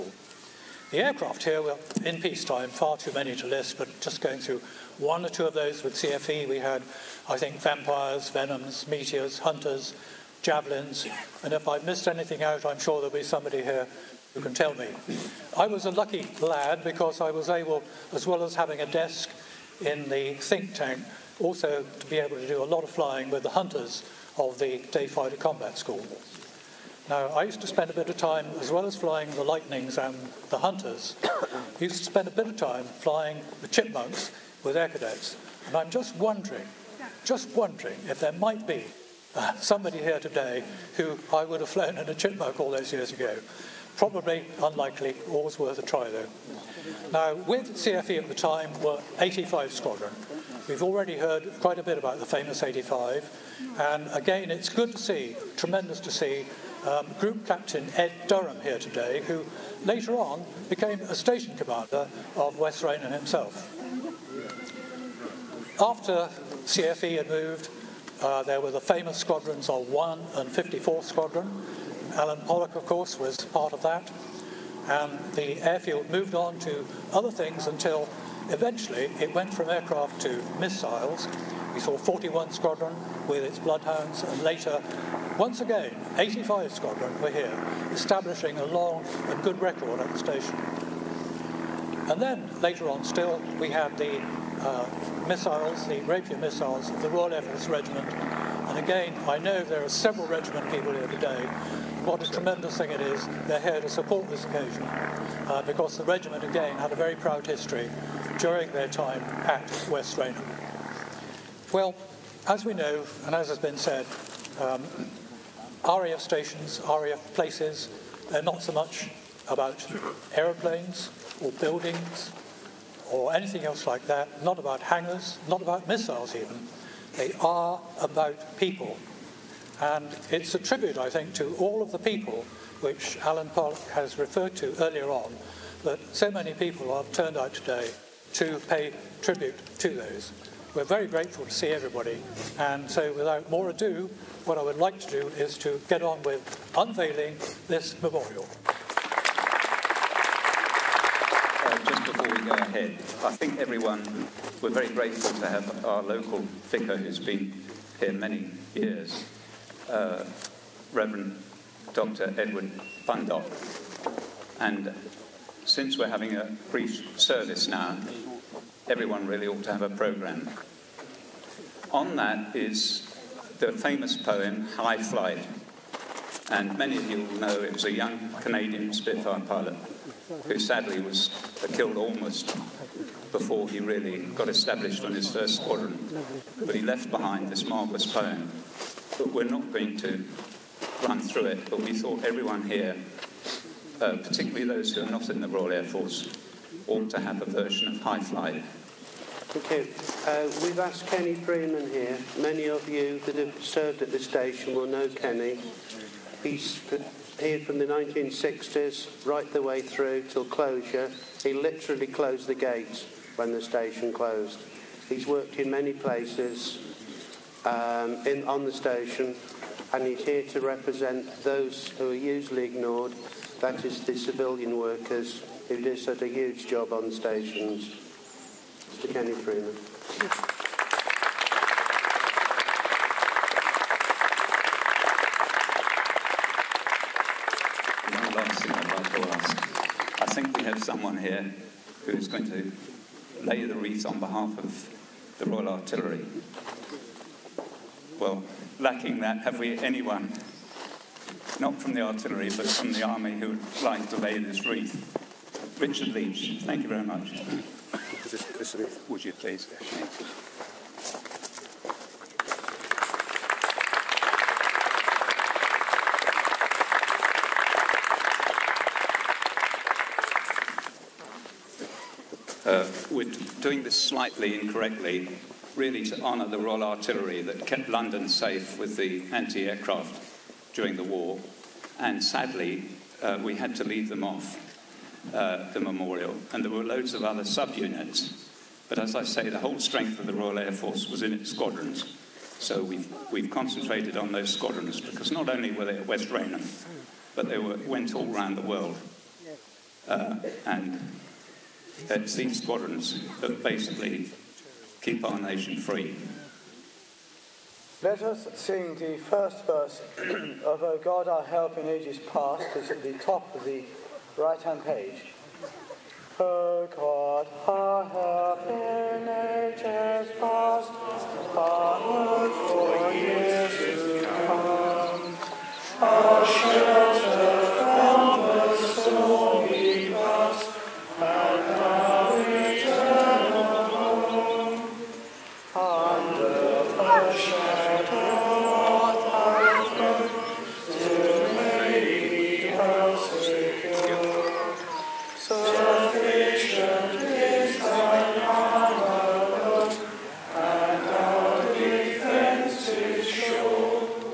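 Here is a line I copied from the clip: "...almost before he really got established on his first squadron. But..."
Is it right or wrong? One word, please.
right.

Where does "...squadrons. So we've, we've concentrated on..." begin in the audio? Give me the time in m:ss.
4:51.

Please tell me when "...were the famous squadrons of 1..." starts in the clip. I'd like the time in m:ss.
1:08.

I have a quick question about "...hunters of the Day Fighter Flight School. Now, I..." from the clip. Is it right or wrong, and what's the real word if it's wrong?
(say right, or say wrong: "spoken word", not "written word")
wrong: "Combat", not "Flight".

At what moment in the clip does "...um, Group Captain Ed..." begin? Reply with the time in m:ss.
0:56.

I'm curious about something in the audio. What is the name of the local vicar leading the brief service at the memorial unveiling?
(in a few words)
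Reverend Dr. Edward Bundock.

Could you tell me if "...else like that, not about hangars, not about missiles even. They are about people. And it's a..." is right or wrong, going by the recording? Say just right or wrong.
right.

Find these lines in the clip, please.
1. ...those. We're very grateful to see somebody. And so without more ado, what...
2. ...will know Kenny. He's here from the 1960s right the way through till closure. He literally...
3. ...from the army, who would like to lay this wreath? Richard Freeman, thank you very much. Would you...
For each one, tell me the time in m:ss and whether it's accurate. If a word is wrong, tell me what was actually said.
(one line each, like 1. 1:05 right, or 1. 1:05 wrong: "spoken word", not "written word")
1. 2:19 wrong: "everybody", not "somebody"
2. 3:24 right
3. 4:12 wrong: "Leach", not "Freeman".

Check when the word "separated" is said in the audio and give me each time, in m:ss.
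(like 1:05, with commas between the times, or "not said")
not said.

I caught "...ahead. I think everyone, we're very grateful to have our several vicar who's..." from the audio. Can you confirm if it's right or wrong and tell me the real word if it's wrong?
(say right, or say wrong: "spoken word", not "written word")
wrong: "local", not "several".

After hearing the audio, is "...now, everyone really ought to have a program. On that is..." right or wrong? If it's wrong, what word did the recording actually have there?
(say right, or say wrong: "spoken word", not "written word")
right.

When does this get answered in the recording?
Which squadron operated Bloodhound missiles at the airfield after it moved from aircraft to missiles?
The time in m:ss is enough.
1:21.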